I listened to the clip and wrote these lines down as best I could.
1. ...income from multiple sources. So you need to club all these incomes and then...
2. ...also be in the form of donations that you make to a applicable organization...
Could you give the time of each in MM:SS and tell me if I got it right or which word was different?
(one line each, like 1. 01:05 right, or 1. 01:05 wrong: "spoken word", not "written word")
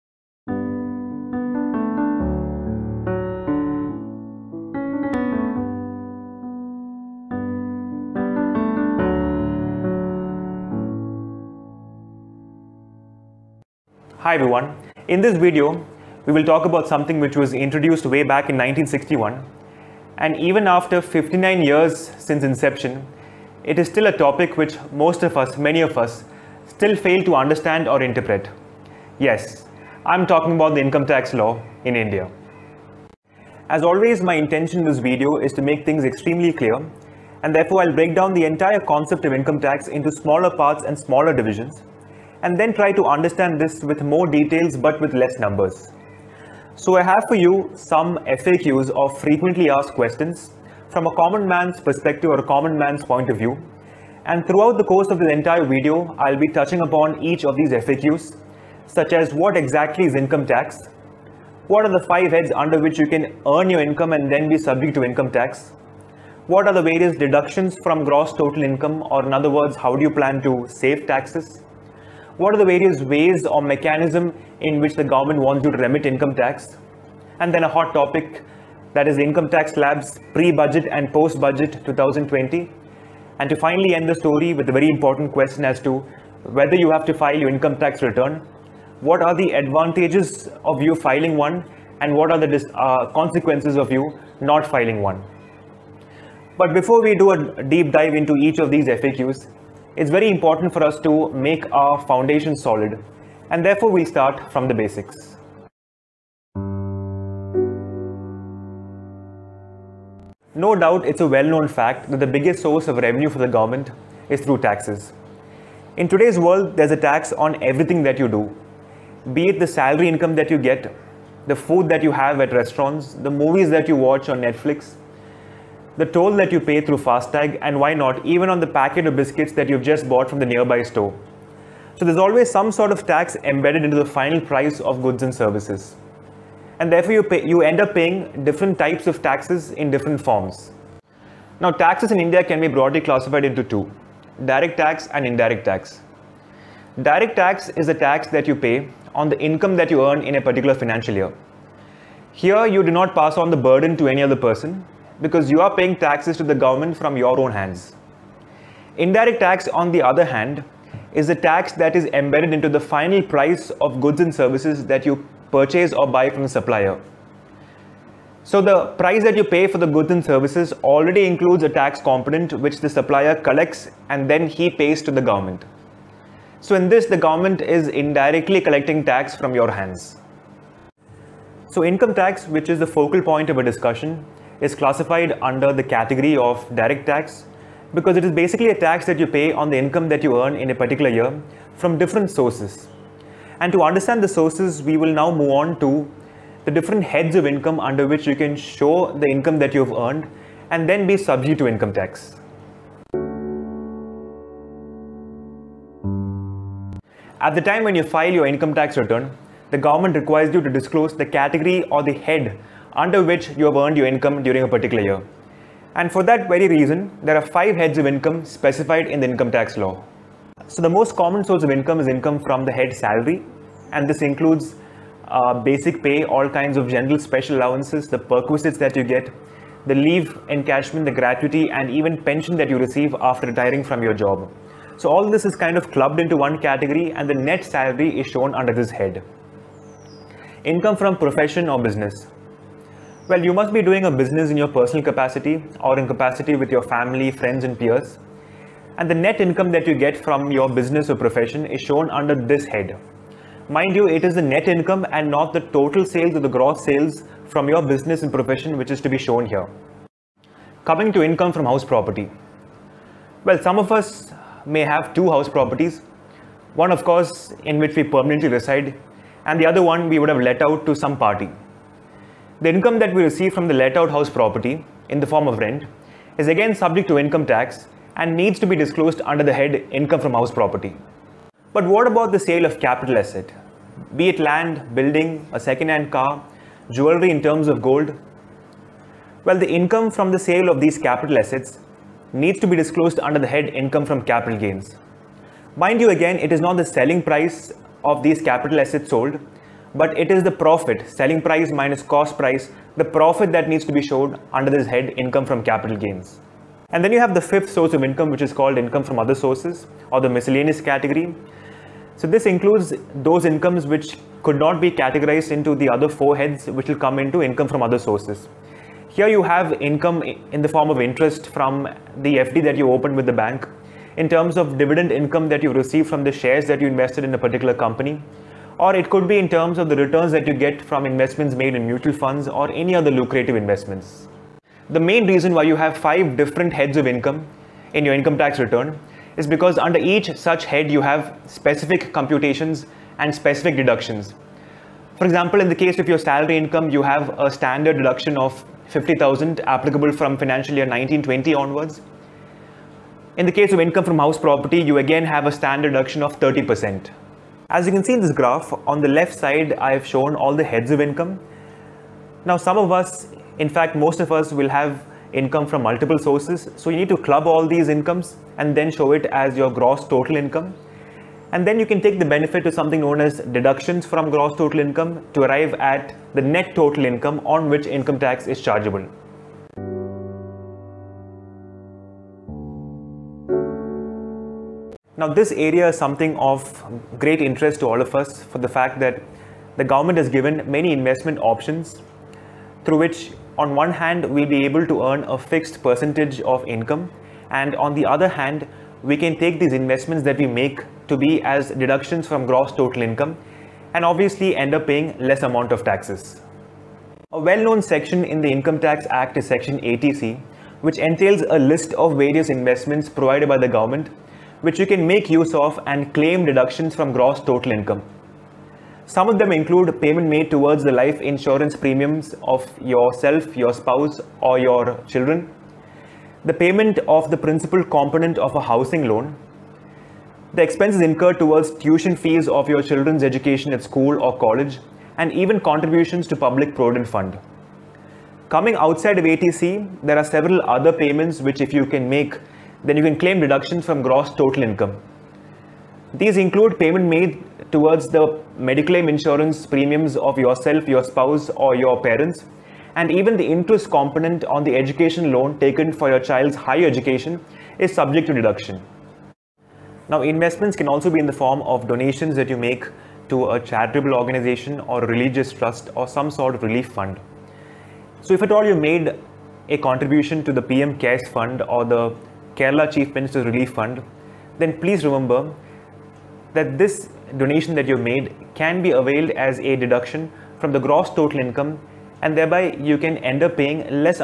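1. 06:05 right
2. 07:40 wrong: "charitable", not "applicable".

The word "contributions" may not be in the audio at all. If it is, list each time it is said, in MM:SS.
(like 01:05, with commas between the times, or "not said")
07:15, 07:49.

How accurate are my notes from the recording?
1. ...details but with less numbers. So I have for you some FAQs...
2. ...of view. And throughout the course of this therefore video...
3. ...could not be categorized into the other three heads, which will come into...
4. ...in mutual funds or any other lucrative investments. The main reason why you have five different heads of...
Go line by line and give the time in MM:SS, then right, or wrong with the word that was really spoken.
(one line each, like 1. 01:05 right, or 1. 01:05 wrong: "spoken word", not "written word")
1. 00:44 right
2. 00:53 wrong: "entire", not "therefore"
3. 05:14 wrong: "four", not "three"
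4. 05:31 right.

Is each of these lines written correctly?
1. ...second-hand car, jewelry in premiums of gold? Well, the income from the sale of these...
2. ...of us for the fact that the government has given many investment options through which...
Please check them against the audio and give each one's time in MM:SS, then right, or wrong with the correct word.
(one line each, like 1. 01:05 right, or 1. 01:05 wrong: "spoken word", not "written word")
1. 04:45 wrong: "terms", not "premiums"
2. 06:28 right.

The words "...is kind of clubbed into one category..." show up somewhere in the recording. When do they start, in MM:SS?
03:55.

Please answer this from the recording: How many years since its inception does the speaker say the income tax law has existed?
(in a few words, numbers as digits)
59.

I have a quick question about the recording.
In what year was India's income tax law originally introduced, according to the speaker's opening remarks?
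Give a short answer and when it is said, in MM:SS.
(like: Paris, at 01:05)
1961, at 00:18.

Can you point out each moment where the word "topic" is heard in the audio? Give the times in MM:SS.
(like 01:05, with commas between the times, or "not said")
00:24, 01:17.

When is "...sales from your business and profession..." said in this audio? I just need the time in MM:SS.
04:16.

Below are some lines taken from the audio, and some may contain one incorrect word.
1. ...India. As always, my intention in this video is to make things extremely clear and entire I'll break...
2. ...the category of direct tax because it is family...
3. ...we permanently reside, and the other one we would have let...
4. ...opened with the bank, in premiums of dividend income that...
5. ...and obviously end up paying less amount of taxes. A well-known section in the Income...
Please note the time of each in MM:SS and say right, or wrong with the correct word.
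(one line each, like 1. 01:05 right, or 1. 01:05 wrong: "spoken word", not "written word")
1. 00:31 wrong: "therefore", not "entire"
2. 03:05 wrong: "basically", not "family"
3. 04:27 right
4. 05:22 wrong: "terms", not "premiums"
5. 06:43 right.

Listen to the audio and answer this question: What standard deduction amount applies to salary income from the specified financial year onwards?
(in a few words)
50,000.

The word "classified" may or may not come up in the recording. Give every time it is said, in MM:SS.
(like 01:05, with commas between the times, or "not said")
02:23, 03:04.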